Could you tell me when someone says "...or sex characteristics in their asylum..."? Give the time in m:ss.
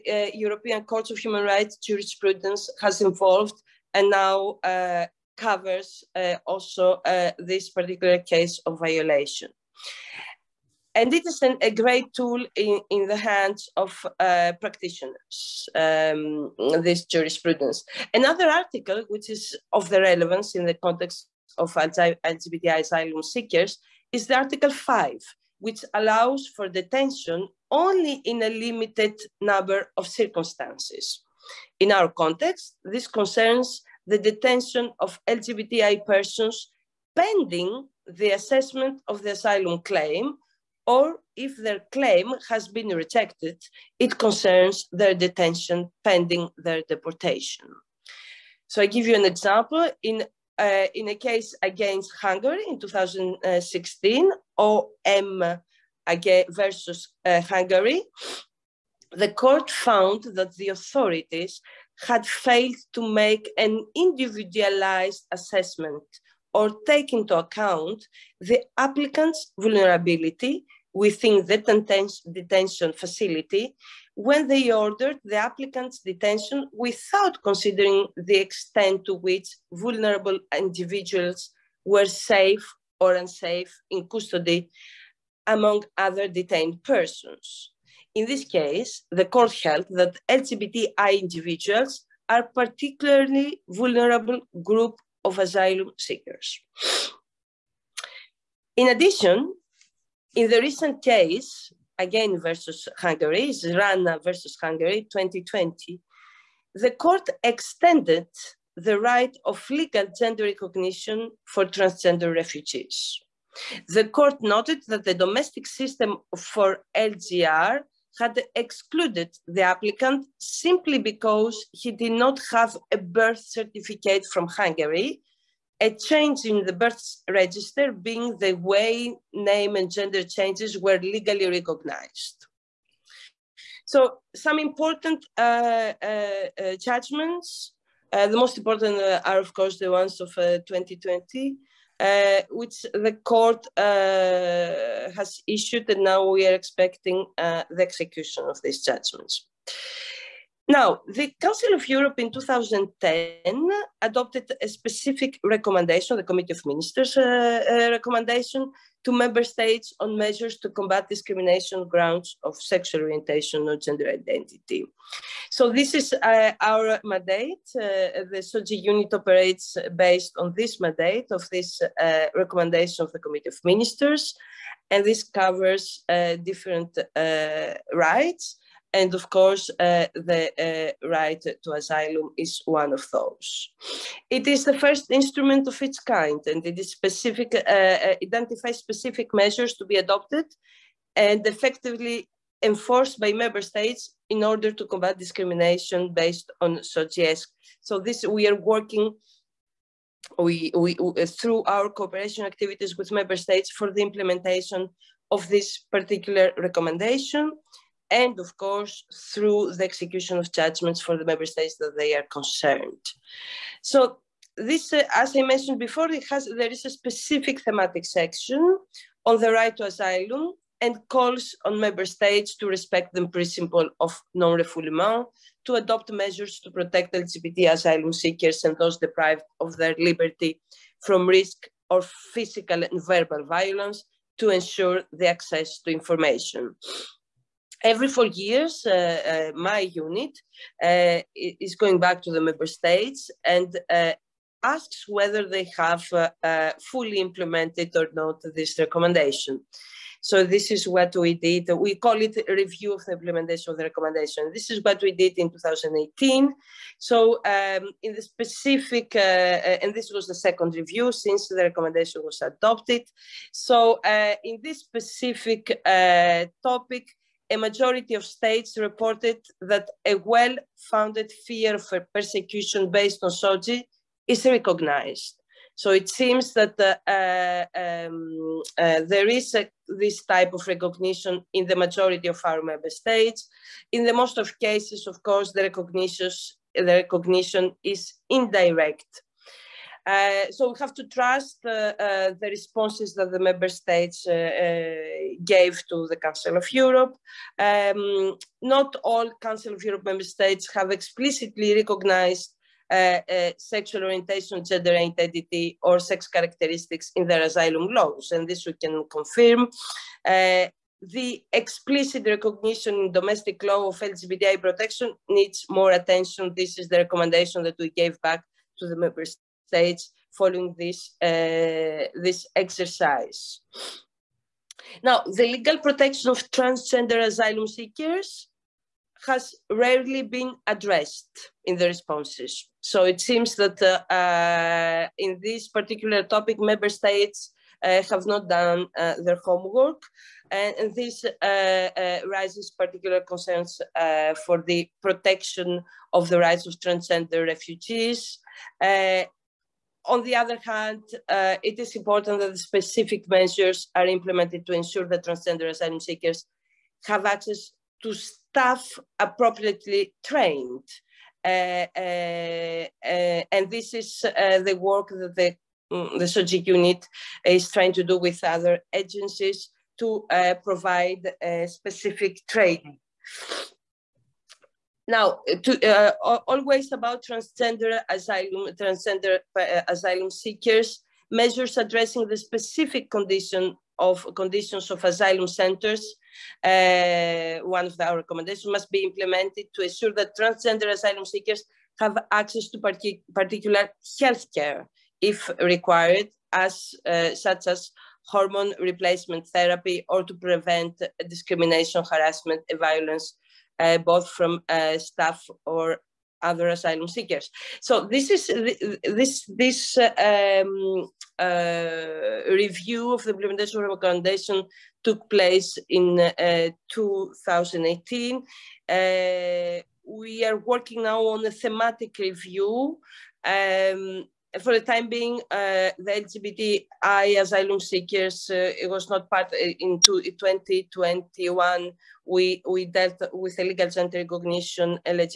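5:05.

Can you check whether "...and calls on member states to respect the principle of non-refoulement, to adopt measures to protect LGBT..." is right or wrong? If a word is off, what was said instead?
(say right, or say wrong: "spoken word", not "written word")
right.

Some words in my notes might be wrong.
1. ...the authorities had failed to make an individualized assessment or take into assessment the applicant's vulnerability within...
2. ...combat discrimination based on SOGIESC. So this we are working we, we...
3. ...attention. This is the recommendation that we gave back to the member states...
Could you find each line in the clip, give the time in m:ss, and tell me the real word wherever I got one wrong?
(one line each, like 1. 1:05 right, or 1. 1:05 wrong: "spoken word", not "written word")
1. 1:00 wrong: "account", not "assessment"
2. 3:14 right
3. 5:15 right.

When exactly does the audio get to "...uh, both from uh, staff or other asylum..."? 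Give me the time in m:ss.
6:43.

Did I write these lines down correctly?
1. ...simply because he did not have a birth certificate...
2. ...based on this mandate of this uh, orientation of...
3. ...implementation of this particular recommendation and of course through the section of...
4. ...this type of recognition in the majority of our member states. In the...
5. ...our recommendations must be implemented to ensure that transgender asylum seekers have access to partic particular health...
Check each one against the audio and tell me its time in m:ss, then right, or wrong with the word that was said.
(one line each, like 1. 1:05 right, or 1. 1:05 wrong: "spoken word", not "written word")
1. 2:00 right
2. 2:49 wrong: "recommendation", not "orientation"
3. 3:24 wrong: "execution", not "section"
4. 4:39 right
5. 6:27 right.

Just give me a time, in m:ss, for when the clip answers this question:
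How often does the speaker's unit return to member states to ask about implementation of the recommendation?
3:57.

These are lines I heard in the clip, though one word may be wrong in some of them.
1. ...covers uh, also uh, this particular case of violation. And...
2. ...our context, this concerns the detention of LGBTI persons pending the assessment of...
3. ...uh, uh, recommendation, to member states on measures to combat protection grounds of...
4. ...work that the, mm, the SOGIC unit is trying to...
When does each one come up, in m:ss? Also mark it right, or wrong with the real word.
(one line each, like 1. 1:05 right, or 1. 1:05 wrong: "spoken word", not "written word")
1. 0:05 right
2. 0:31 right
3. 2:37 wrong: "discrimination", not "protection"
4. 6:04 right.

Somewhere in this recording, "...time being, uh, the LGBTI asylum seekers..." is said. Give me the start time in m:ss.
7:04.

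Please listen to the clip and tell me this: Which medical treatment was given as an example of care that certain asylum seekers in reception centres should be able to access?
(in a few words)
hormone replacement therapy.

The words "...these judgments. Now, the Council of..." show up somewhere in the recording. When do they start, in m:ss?
2:28.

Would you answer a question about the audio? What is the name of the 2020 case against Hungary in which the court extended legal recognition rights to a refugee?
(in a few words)
Rana versus Hungary.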